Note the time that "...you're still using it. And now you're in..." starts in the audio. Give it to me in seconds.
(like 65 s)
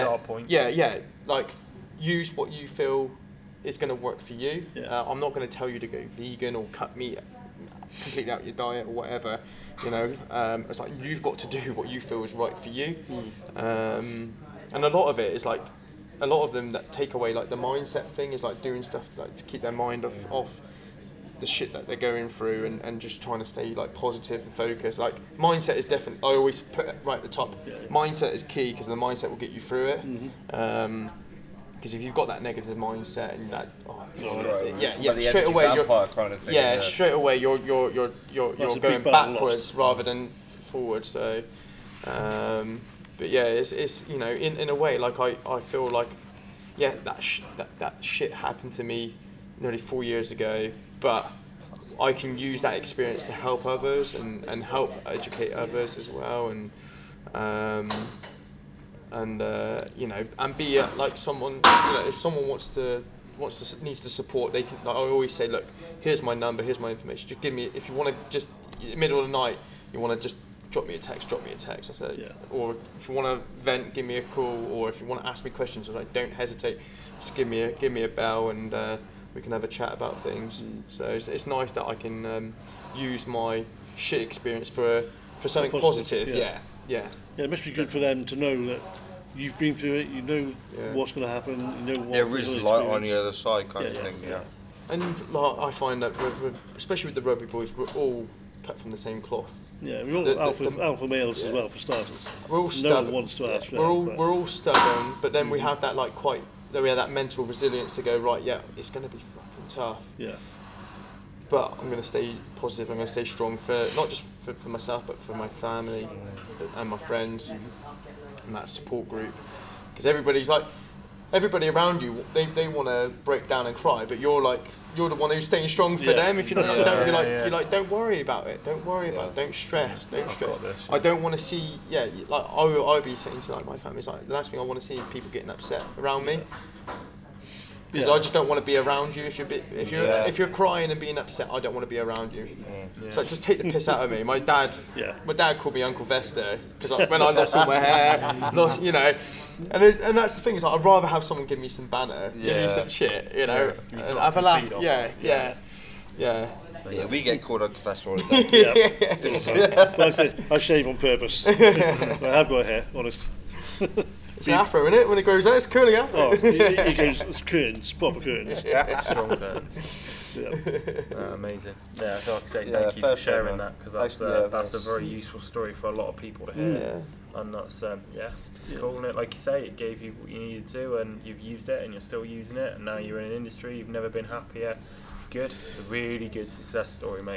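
181 s.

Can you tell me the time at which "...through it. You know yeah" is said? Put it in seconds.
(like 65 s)
89 s.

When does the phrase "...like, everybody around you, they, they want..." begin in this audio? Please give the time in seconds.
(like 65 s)
120 s.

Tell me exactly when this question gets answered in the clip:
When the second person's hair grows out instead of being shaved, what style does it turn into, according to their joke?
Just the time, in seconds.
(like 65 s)
165 s.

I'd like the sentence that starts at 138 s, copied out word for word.
I just don't want to be around you if you're bit, if you're yeah.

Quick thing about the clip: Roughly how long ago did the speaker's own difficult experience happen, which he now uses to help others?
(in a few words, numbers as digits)
nearly 4 years.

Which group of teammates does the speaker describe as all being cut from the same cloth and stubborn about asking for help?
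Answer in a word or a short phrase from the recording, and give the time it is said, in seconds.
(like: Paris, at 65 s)
the rugby boys, at 97 s.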